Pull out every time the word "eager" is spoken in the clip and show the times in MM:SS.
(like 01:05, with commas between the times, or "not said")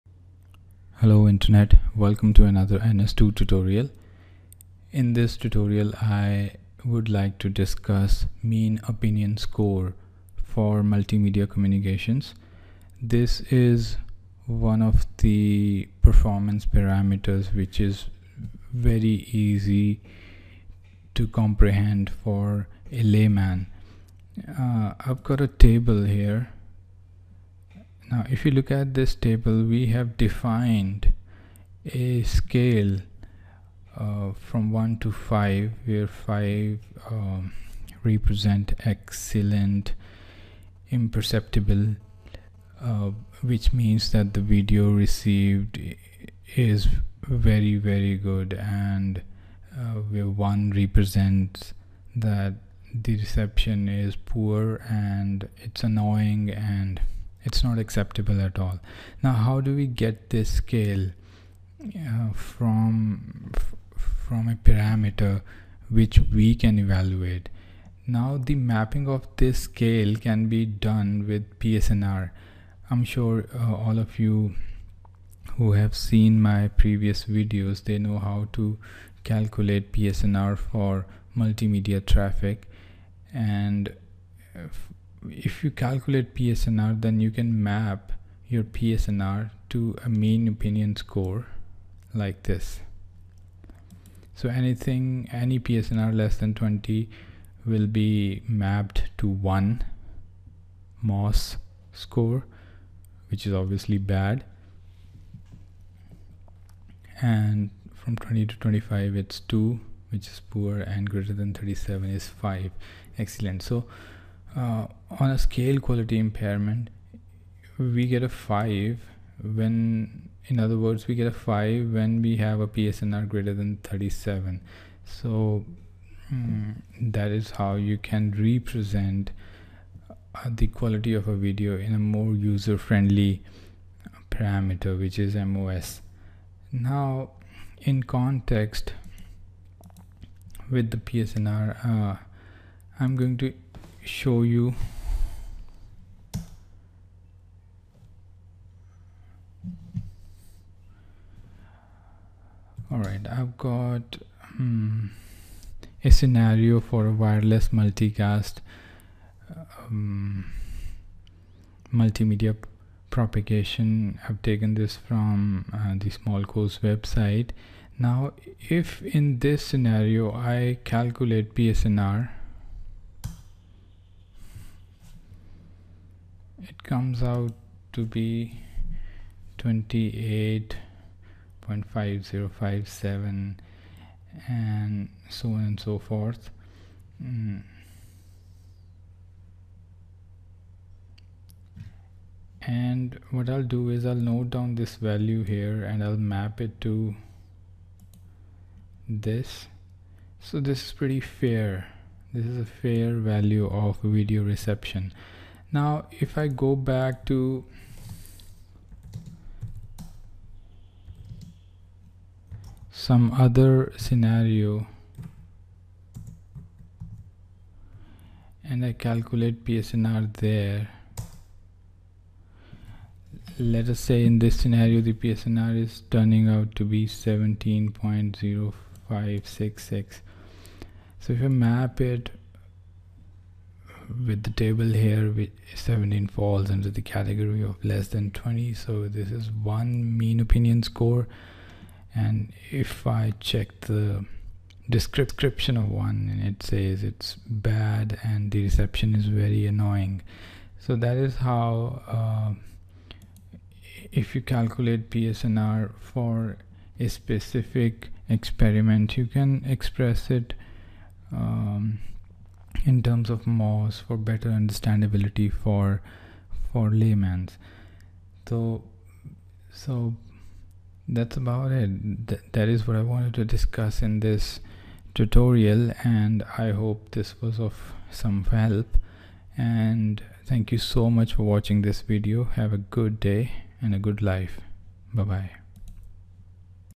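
not said.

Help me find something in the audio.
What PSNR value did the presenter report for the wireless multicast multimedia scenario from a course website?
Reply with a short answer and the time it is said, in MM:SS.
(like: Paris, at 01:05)
28.5057, at 02:59.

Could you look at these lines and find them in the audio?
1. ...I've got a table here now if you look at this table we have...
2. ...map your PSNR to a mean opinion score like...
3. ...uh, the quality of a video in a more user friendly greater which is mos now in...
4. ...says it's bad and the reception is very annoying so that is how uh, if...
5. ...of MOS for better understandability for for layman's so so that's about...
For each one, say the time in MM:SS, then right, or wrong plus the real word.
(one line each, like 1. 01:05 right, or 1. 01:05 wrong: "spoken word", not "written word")
1. 00:24 right
2. 01:27 right
3. 02:10 wrong: "parameter", not "greater"
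4. 04:06 right
5. 04:23 right.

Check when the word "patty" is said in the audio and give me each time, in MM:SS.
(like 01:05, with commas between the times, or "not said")
not said.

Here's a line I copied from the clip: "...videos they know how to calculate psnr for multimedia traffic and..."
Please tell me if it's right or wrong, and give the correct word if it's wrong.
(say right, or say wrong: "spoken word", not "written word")
right.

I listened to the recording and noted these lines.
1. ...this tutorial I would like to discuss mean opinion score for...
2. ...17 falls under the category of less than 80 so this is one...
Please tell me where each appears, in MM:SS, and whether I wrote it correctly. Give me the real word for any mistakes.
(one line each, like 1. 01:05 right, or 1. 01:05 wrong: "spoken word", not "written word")
1. 00:05 right
2. 03:55 wrong: "20", not "80".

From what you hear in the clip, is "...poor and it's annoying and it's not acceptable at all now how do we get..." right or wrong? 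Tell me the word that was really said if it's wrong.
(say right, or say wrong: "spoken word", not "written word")
right.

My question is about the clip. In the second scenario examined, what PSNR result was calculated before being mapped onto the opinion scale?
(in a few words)
17.0566.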